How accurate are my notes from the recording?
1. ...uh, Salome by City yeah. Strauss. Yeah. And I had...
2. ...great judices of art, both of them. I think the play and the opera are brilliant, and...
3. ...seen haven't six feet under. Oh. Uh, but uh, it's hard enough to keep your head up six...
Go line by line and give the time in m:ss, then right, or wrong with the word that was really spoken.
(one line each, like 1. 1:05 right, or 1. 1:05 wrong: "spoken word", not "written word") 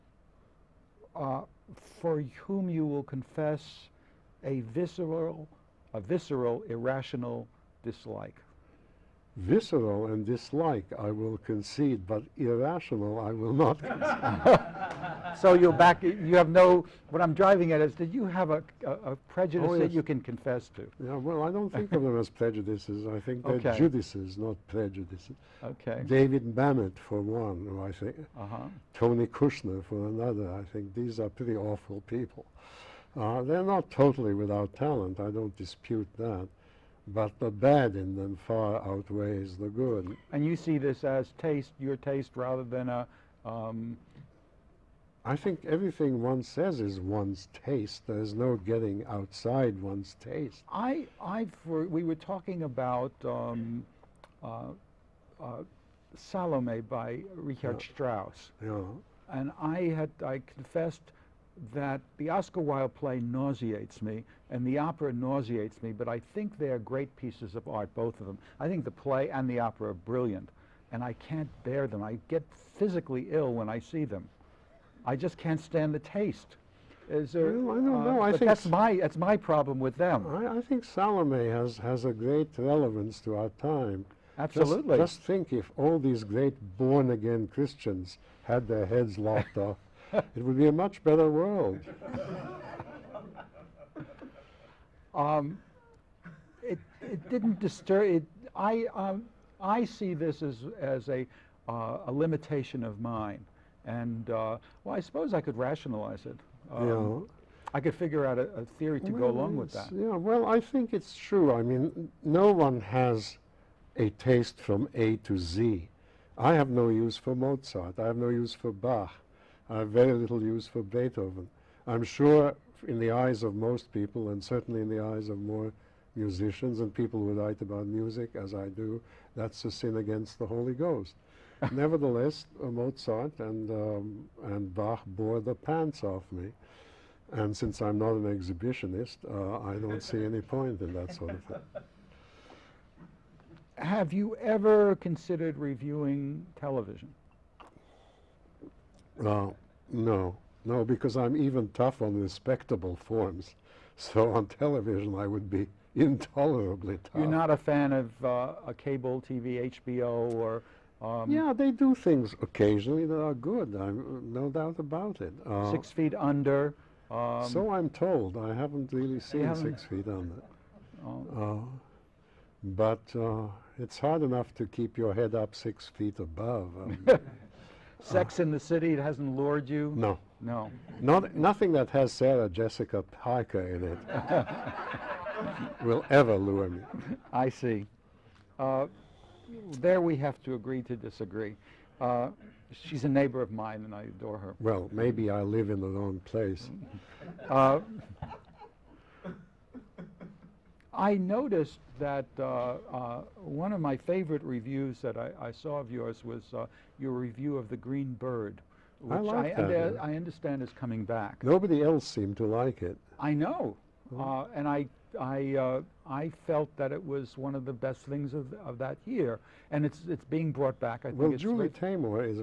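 1. 0:55 wrong: "Richard", not "City"
2. 1:06 wrong: "pieces", not "judices"
3. 2:49 right.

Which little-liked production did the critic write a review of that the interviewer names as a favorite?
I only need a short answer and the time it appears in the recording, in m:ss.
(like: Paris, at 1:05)
The Green Bird, at 3:27.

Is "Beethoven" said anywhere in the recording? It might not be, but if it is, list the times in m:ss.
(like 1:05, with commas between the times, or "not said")
2:00.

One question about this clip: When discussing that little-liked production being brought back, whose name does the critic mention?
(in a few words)
Julie Taymor.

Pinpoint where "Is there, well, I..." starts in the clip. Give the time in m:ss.
1:17.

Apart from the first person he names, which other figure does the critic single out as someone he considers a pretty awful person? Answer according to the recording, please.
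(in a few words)
Tony Kushner.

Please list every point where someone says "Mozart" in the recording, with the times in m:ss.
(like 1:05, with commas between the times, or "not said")
1:57, 2:12.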